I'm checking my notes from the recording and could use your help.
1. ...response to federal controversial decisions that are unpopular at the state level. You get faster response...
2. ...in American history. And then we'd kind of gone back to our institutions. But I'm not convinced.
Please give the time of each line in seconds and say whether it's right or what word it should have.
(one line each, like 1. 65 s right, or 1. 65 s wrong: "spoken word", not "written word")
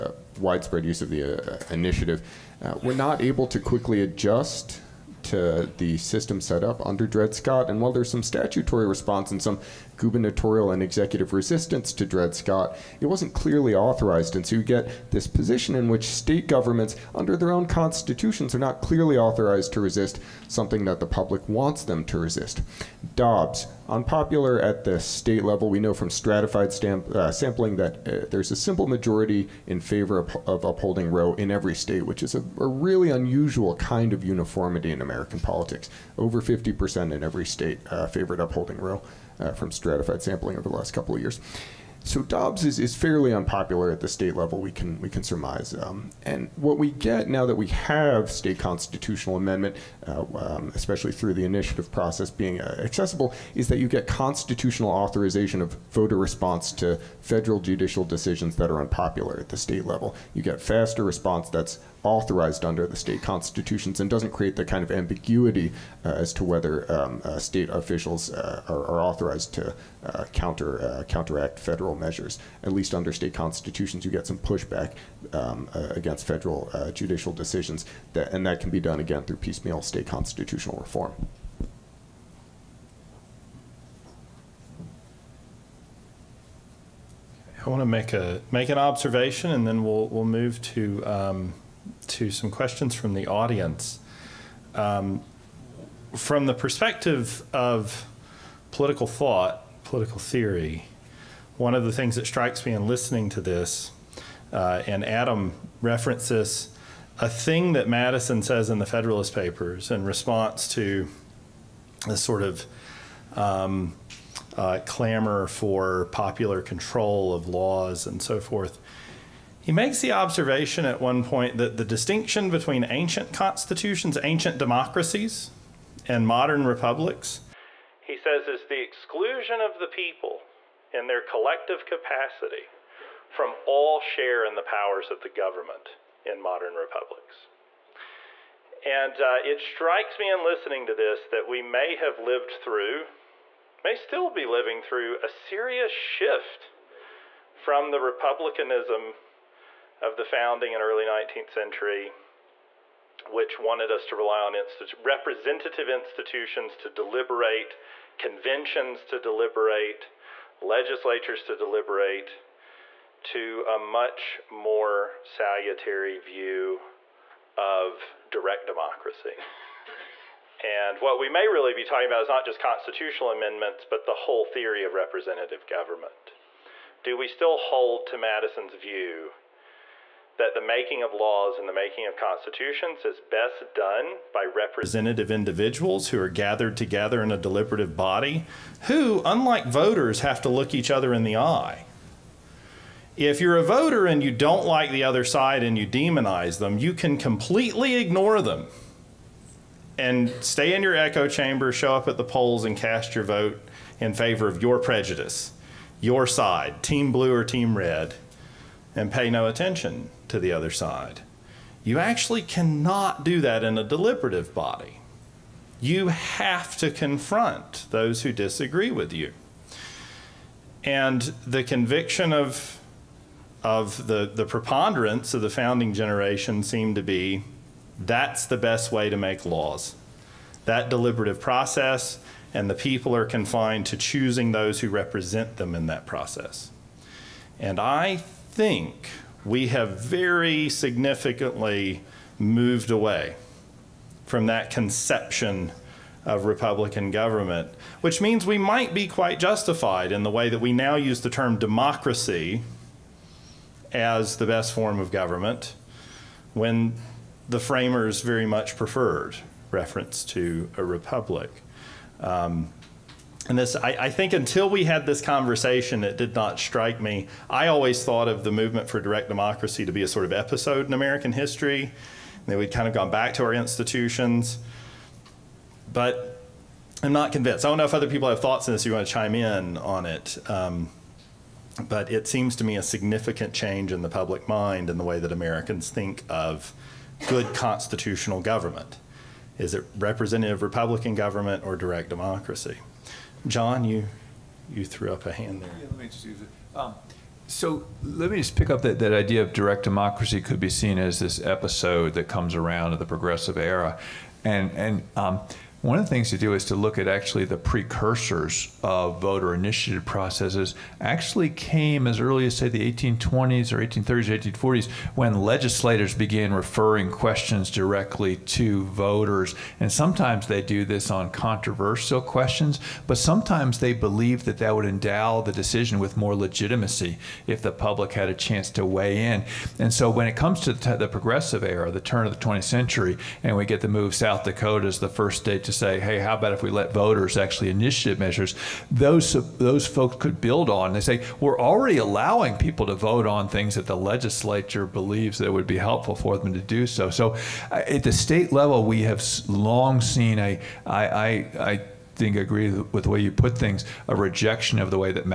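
1. 56 s wrong: "judicial", not "controversial"
2. 270 s right.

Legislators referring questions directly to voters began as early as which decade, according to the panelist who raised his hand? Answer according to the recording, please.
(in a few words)
1820s.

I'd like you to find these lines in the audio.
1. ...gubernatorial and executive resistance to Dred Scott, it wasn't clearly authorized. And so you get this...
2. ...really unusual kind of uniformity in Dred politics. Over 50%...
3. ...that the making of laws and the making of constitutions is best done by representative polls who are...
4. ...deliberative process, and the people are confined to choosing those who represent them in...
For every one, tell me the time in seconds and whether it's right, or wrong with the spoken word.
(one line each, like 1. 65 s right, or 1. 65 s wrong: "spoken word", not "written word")
1. 9 s right
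2. 32 s wrong: "American", not "Dred"
3. 180 s wrong: "individuals", not "polls"
4. 230 s right.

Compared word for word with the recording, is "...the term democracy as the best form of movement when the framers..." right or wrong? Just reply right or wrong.
wrong.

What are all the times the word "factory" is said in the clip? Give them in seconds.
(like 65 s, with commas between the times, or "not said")
not said.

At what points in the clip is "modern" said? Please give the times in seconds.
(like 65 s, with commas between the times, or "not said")
126 s, 136 s.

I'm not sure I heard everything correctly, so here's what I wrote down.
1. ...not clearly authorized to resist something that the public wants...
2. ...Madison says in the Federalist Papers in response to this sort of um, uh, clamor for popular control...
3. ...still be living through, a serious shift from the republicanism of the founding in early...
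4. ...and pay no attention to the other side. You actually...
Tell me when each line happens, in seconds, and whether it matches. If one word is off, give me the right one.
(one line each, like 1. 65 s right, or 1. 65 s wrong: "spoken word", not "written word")
1. 18 s right
2. 107 s right
3. 143 s right
4. 208 s right.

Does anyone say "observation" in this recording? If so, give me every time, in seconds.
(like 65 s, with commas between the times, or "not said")
88 s, 120 s.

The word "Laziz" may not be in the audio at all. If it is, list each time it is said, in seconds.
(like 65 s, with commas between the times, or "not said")
not said.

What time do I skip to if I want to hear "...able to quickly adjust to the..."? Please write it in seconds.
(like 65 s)
3 s.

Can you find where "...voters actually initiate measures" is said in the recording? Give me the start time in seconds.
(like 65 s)
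336 s.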